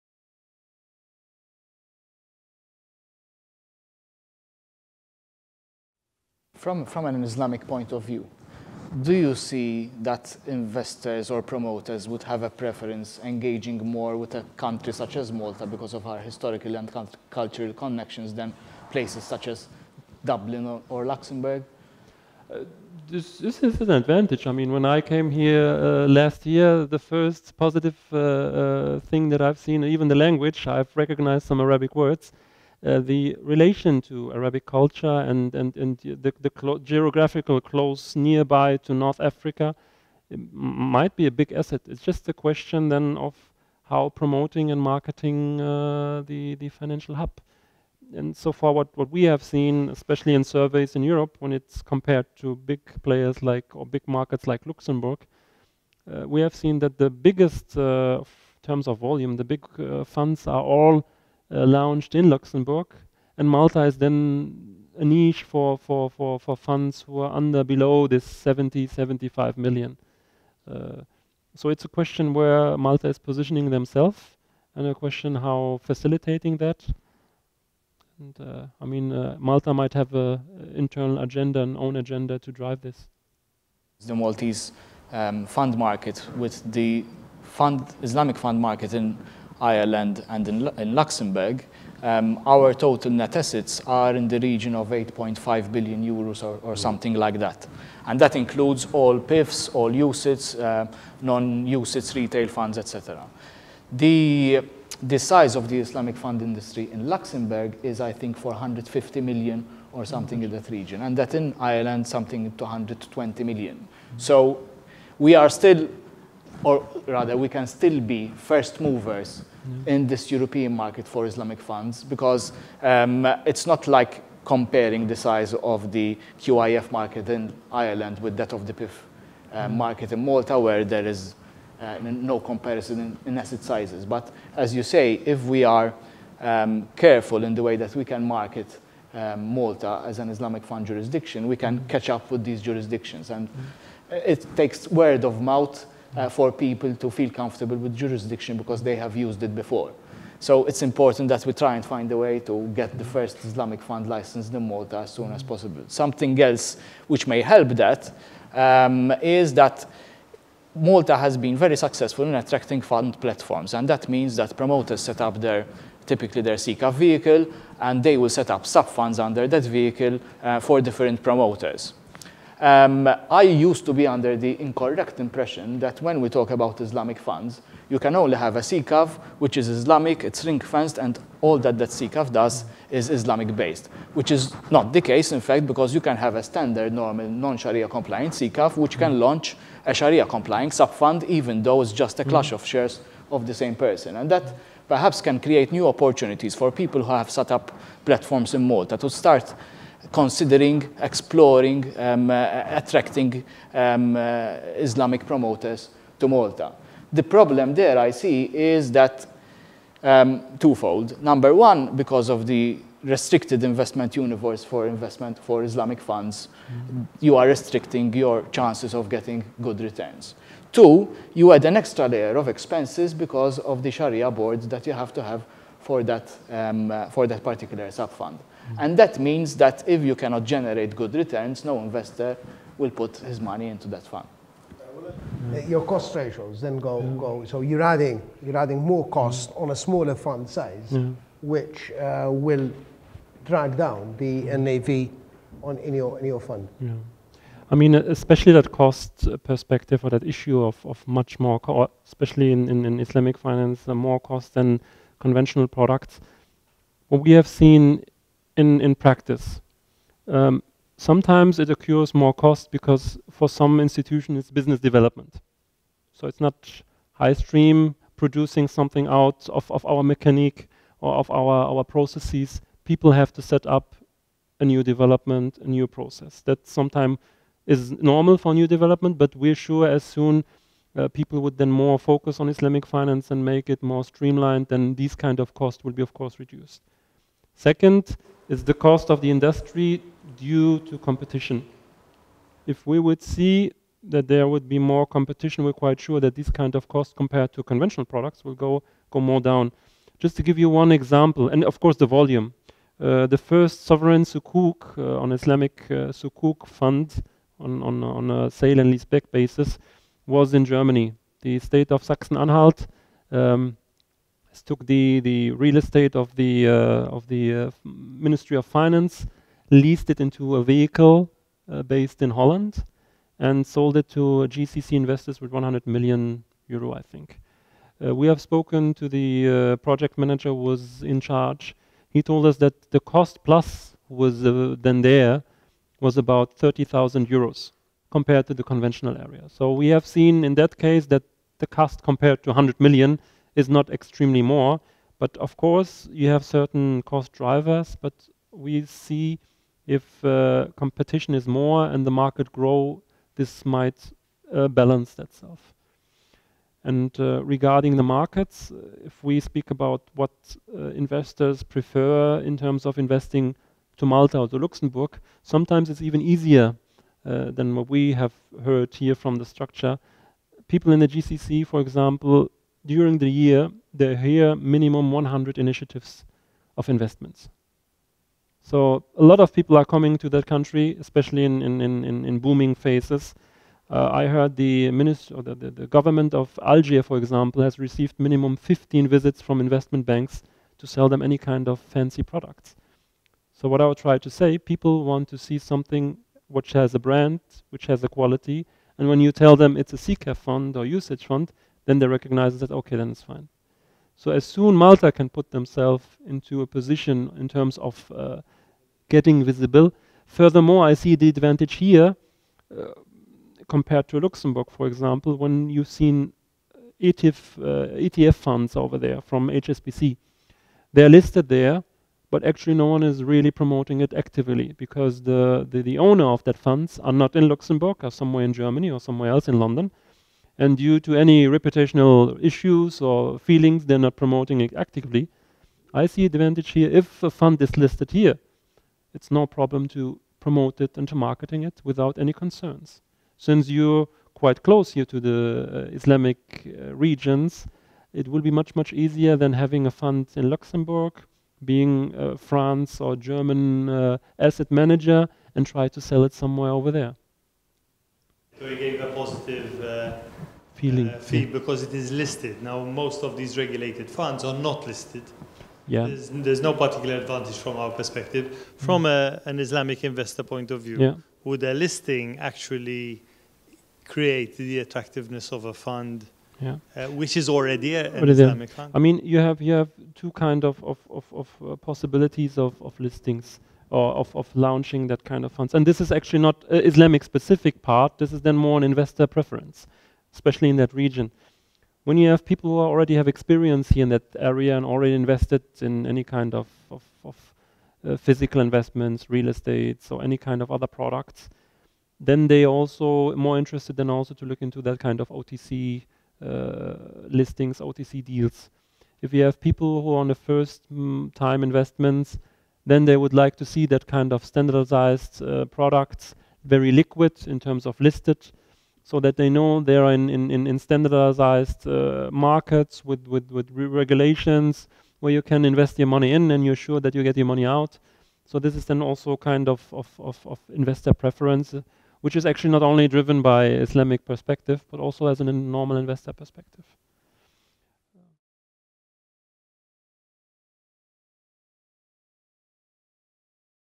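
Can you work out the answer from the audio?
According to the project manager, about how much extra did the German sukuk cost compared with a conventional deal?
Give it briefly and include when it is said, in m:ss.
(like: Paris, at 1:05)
30,000 euros, at 5:36.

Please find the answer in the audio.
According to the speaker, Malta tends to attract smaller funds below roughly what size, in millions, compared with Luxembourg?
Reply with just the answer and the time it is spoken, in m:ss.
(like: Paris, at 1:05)
70 to 75 million, at 1:08.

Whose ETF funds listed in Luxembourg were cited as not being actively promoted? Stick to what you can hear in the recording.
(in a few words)
HSBC.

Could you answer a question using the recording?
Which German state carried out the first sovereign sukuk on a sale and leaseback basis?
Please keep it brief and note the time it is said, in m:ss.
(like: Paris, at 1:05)
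Sachsen-Anhalt, at 5:12.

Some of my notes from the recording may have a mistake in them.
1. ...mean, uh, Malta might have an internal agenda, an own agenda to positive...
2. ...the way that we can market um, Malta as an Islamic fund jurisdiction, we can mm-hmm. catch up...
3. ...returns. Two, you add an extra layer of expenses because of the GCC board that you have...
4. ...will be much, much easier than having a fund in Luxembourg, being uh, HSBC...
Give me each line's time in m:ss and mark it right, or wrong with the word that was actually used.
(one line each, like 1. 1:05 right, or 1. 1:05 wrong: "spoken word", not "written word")
1. 1:18 wrong: "drive", not "positive"
2. 2:17 right
3. 3:39 wrong: "Sharia", not "GCC"
4. 7:28 wrong: "France", not "HSBC".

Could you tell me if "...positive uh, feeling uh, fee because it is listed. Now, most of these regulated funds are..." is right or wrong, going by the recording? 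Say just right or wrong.
right.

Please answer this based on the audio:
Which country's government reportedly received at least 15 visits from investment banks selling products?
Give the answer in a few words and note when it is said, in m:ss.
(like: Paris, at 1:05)
Algeria, at 6:26.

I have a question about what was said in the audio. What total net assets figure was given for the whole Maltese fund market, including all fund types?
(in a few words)
8.5 billion euros.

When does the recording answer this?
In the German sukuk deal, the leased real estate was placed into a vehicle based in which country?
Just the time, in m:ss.
5:22.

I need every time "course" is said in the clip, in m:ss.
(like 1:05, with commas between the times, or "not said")
4:46, 5:01, 5:45.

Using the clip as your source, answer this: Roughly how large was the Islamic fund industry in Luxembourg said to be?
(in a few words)
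450 million.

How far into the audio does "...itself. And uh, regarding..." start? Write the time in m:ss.
5:55.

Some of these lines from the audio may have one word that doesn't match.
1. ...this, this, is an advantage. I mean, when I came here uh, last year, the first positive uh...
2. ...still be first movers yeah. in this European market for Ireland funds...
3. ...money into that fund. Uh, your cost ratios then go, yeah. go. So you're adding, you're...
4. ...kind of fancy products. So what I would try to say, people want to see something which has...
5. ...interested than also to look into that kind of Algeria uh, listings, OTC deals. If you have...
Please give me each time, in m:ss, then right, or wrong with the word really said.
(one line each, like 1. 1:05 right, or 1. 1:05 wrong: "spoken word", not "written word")
1. 0:23 right
2. 1:57 wrong: "Islamic", not "Ireland"
3. 3:53 right
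4. 6:31 right
5. 8:23 wrong: "OTC", not "Algeria".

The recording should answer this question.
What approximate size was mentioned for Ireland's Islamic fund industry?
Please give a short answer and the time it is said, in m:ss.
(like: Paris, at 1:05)
120 million, at 1:52.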